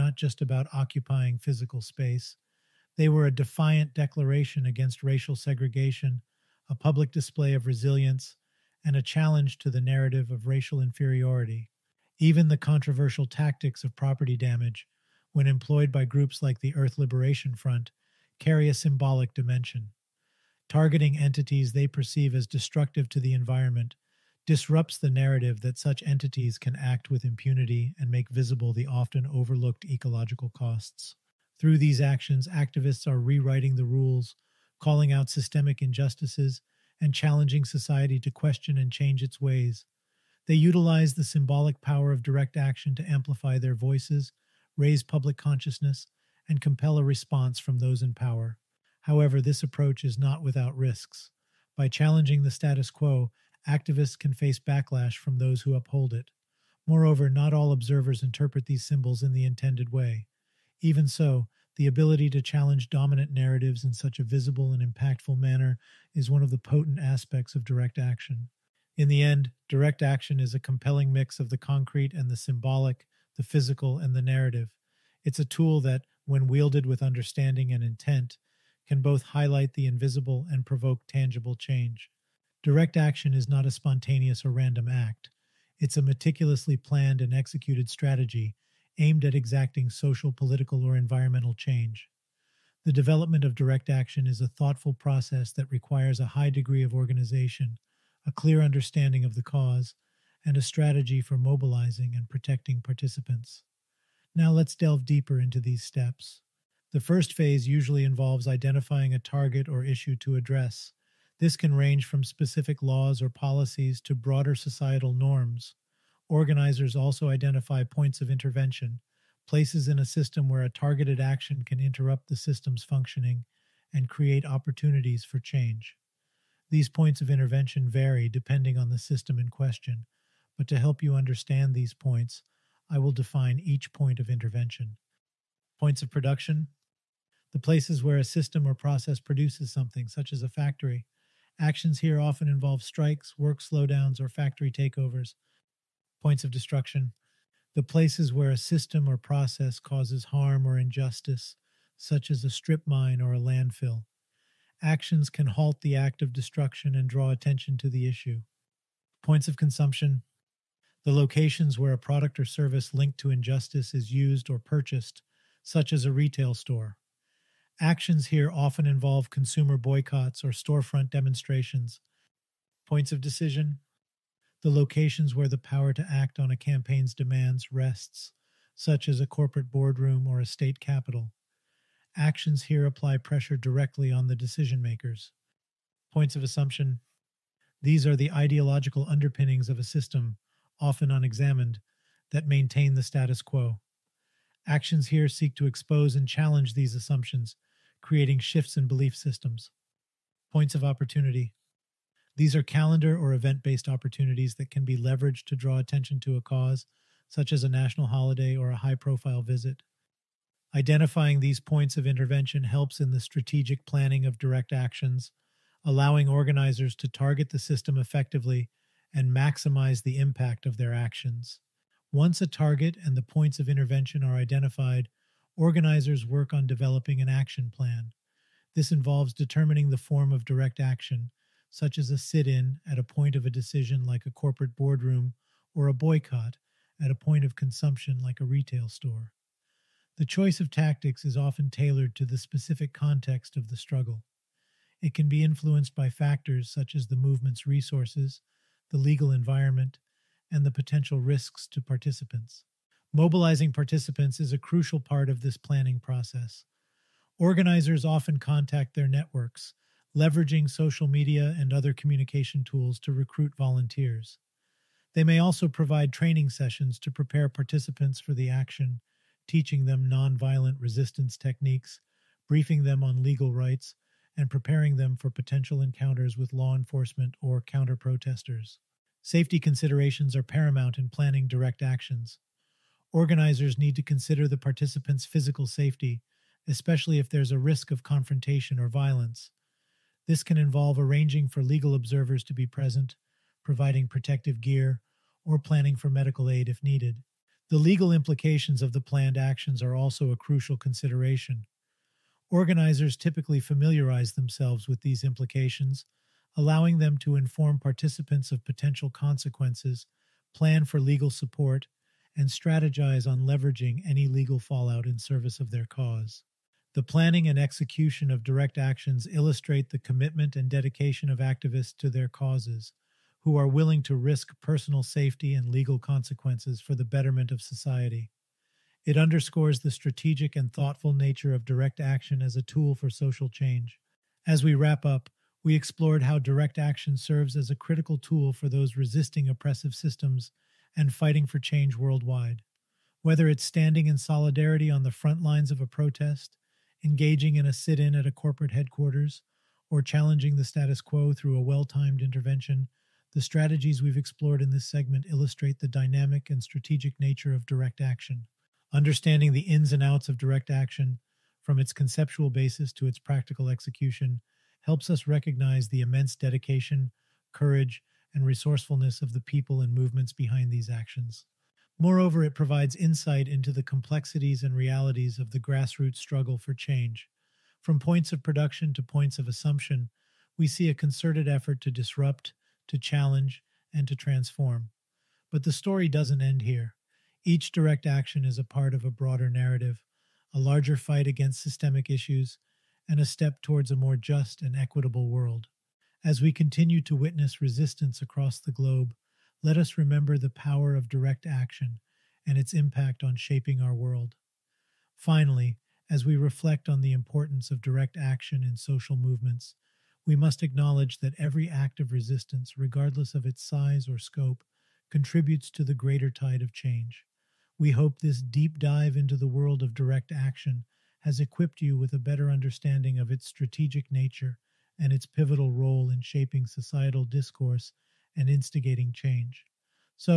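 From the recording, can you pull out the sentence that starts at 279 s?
Safety considerations are paramount in planning direct actions.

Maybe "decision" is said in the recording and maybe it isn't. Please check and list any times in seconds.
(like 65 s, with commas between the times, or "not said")
173 s, 184 s, 233 s.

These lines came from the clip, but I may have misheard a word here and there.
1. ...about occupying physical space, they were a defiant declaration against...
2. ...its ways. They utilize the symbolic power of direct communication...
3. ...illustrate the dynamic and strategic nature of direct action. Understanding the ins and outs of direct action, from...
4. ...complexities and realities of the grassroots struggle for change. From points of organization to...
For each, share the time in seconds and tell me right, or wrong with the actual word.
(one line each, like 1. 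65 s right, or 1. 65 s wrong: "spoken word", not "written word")
1. 0 s right
2. 39 s wrong: "action", not "communication"
3. 355 s right
4. 373 s wrong: "production", not "organization".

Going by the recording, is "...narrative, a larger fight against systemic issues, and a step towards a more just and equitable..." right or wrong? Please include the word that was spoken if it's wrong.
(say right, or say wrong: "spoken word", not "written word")
right.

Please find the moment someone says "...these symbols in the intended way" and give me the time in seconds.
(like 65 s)
58 s.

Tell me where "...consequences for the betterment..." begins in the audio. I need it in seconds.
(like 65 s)
325 s.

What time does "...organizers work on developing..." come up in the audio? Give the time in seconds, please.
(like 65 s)
225 s.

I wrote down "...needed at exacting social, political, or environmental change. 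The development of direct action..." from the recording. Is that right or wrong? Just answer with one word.
wrong.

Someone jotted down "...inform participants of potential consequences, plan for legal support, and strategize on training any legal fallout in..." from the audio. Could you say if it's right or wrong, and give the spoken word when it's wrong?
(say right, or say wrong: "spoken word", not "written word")
wrong: "leveraging", not "training".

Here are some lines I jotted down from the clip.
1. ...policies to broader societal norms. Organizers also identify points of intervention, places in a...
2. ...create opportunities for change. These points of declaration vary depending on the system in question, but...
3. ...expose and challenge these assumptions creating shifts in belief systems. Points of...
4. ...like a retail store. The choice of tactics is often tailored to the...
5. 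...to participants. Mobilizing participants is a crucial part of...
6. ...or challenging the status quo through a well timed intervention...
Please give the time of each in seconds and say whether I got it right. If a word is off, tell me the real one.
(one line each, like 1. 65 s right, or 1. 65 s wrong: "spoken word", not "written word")
1. 113 s right
2. 124 s wrong: "intervention", not "declaration"
3. 195 s right
4. 238 s right
5. 251 s right
6. 349 s right.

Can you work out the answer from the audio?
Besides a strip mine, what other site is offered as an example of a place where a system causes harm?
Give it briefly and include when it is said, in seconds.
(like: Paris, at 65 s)
A landfill, at 153 s.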